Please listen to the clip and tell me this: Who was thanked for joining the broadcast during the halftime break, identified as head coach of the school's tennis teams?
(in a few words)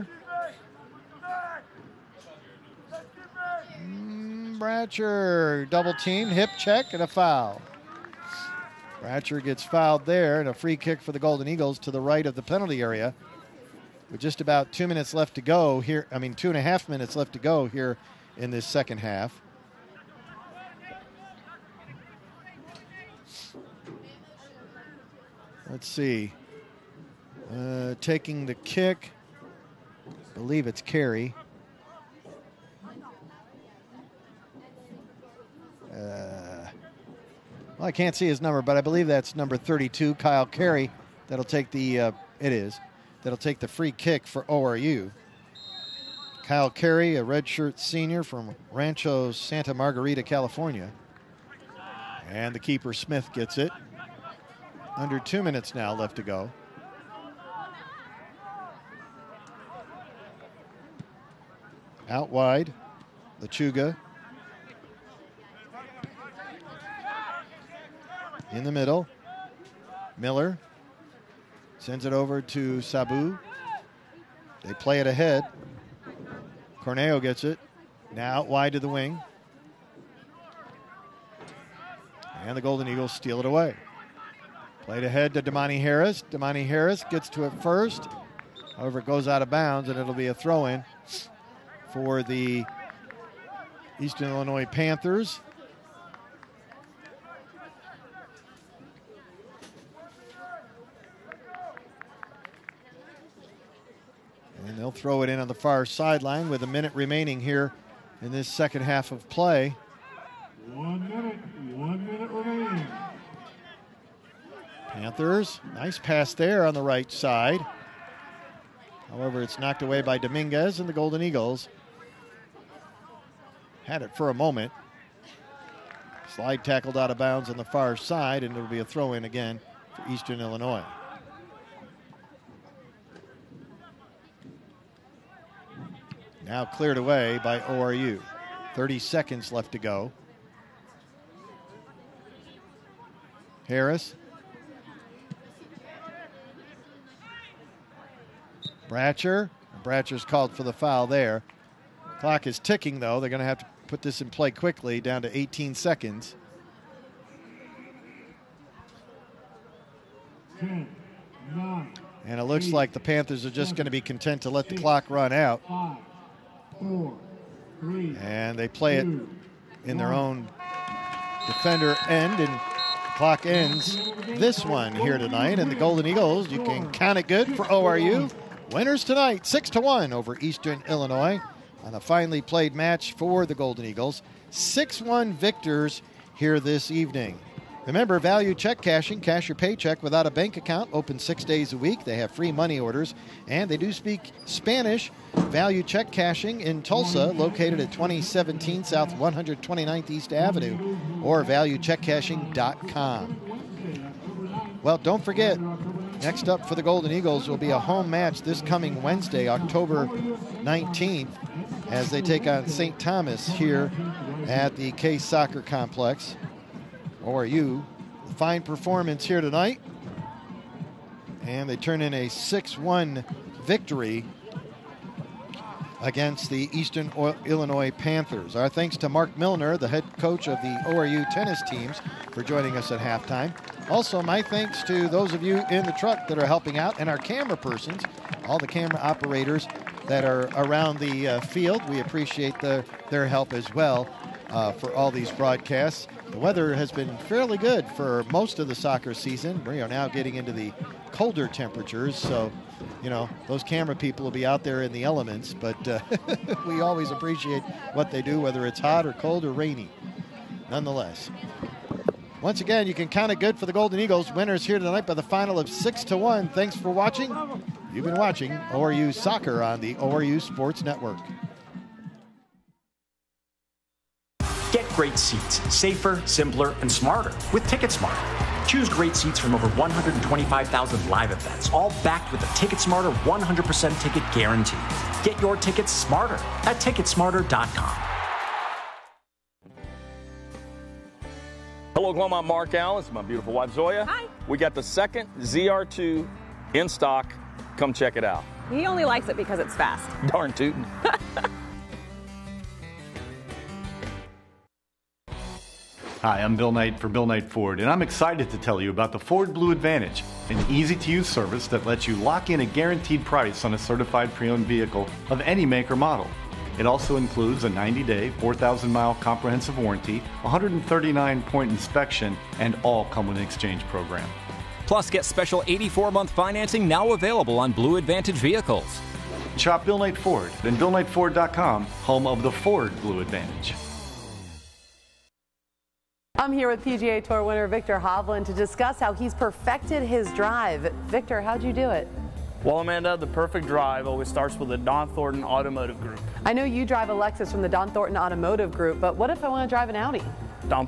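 Mark Milner.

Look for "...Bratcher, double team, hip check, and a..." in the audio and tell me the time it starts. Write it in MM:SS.
00:04.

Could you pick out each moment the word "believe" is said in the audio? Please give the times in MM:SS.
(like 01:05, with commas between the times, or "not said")
00:30, 00:38.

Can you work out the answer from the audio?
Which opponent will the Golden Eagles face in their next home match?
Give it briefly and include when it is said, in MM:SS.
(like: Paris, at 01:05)
St. Thomas, at 03:32.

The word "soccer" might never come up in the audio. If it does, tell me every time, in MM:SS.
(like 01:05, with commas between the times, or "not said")
03:35, 04:08, 04:29.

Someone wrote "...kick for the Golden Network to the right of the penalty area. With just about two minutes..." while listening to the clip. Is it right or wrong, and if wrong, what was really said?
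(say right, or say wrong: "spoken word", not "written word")
wrong: "Eagles", not "Network".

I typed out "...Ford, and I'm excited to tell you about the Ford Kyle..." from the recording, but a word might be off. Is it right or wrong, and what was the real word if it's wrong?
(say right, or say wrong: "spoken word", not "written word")
wrong: "Blue", not "Kyle".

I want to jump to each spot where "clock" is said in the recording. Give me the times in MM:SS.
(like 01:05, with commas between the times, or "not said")
02:32, 02:44, 02:53.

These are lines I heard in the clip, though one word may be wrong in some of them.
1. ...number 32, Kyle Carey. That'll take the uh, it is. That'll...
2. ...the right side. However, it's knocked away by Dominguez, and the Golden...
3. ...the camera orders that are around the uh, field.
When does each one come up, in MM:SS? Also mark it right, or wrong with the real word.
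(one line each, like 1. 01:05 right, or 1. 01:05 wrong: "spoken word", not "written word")
1. 00:39 right
2. 01:56 right
3. 03:58 wrong: "operators", not "orders".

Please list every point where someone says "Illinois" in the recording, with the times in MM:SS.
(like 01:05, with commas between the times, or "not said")
01:34, 02:10, 03:00, 03:47.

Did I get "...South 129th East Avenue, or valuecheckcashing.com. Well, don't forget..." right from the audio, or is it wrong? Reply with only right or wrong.
right.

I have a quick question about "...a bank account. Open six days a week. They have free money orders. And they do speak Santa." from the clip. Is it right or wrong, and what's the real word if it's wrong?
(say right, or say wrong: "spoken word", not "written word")
wrong: "Spanish", not "Santa".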